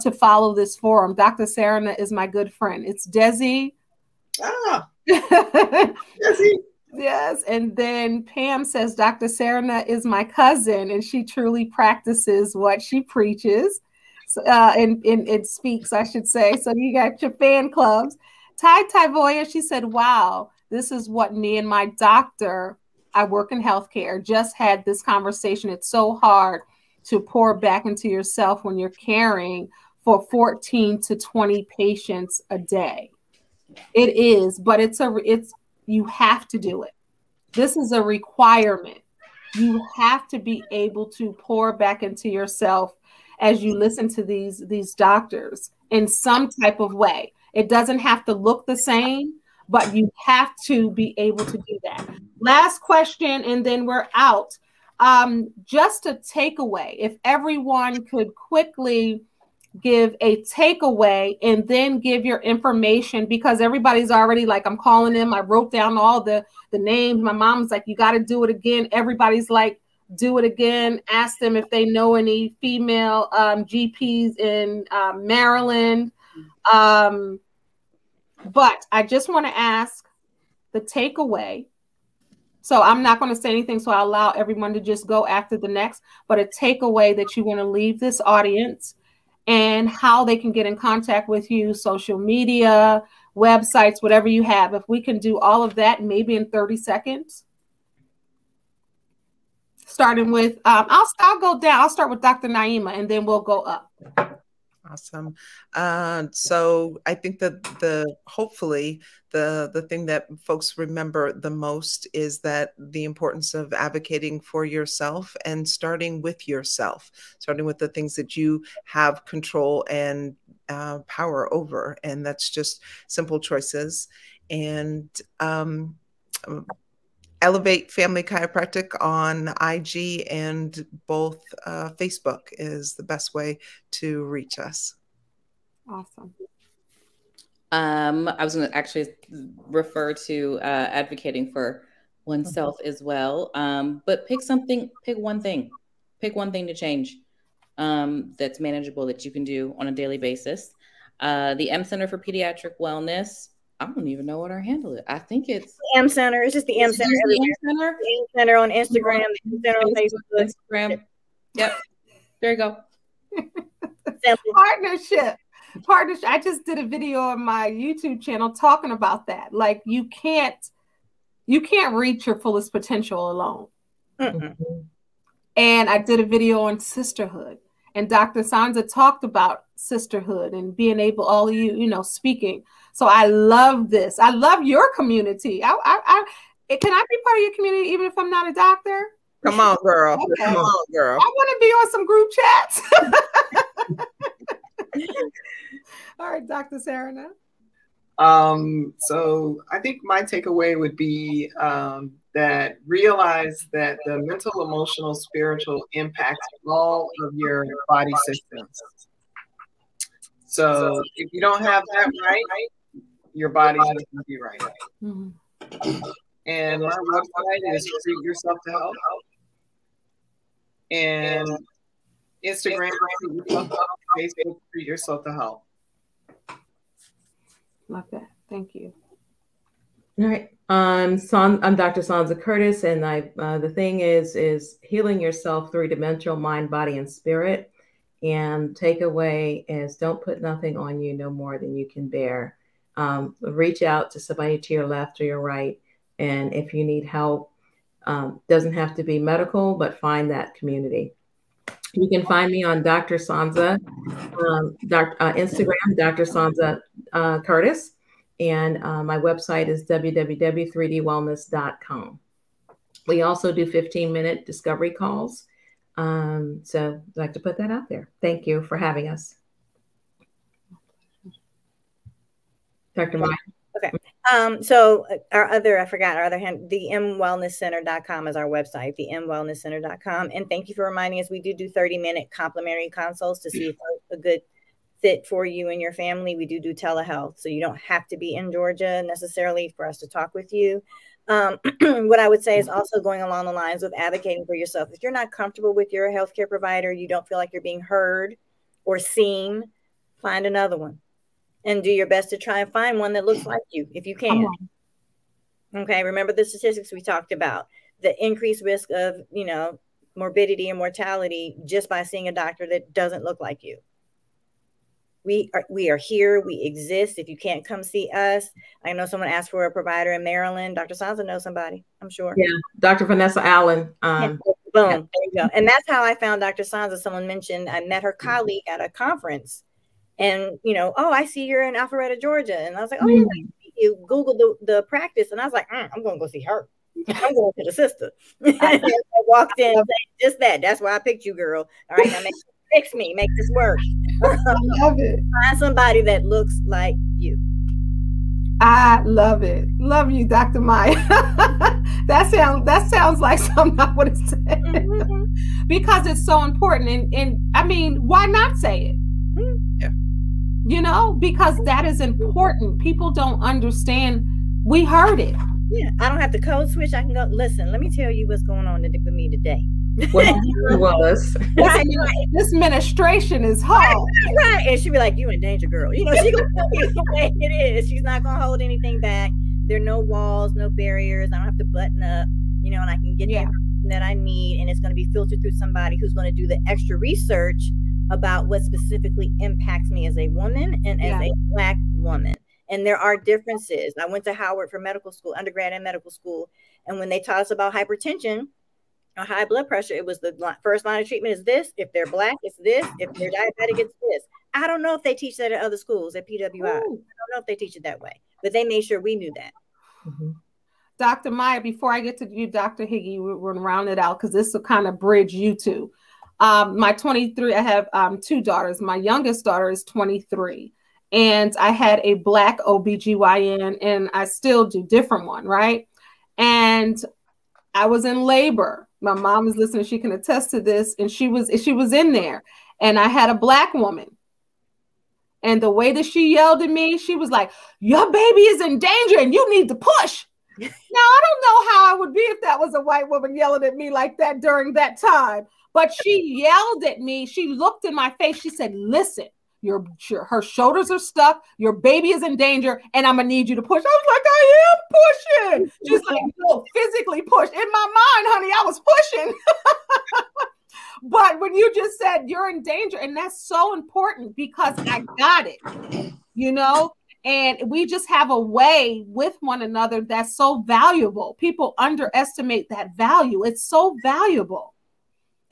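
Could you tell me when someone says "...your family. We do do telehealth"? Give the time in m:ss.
4:45.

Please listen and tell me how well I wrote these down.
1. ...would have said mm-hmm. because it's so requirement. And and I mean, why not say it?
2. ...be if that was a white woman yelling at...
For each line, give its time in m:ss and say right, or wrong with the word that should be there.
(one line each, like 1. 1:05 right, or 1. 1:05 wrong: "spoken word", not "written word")
1. 5:53 wrong: "important", not "requirement"
2. 7:22 right.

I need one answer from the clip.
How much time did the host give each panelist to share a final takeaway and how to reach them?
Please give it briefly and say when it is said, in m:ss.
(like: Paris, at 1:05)
30 seconds, at 1:36.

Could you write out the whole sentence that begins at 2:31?
Uh, the M Center for Pediatric Wellness I don't even know what our handle is.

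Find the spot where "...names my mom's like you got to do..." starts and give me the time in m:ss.
1:06.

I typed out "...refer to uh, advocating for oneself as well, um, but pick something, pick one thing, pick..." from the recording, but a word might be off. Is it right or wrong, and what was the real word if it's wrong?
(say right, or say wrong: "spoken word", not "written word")
right.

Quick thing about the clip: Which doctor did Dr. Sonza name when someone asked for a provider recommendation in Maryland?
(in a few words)
Dr. Vanessa Allen.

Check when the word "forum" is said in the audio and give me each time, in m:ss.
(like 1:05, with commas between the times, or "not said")
0:00.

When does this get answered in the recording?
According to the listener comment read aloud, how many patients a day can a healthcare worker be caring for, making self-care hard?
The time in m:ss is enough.
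0:30.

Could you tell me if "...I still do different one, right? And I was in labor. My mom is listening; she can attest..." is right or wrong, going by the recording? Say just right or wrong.
right.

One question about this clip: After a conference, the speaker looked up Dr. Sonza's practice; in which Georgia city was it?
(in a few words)
Alpharetta.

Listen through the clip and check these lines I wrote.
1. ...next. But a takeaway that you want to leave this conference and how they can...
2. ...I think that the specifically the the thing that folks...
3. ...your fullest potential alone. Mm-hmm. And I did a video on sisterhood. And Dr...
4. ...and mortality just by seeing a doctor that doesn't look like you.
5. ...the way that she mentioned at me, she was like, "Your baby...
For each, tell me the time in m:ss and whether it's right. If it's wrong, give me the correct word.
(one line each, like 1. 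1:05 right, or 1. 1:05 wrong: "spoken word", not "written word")
1. 1:25 wrong: "audience", not "conference"
2. 1:47 wrong: "hopefully", not "specifically"
3. 2:52 right
4. 5:10 right
5. 7:15 wrong: "yelled", not "mentioned".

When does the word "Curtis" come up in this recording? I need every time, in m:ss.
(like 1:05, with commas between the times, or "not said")
3:52, 4:17.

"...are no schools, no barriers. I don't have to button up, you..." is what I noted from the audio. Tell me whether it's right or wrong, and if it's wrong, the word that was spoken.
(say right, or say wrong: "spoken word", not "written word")
wrong: "walls", not "schools".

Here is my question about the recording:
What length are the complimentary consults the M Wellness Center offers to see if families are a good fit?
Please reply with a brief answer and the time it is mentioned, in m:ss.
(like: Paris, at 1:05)
30 minutes, at 4:41.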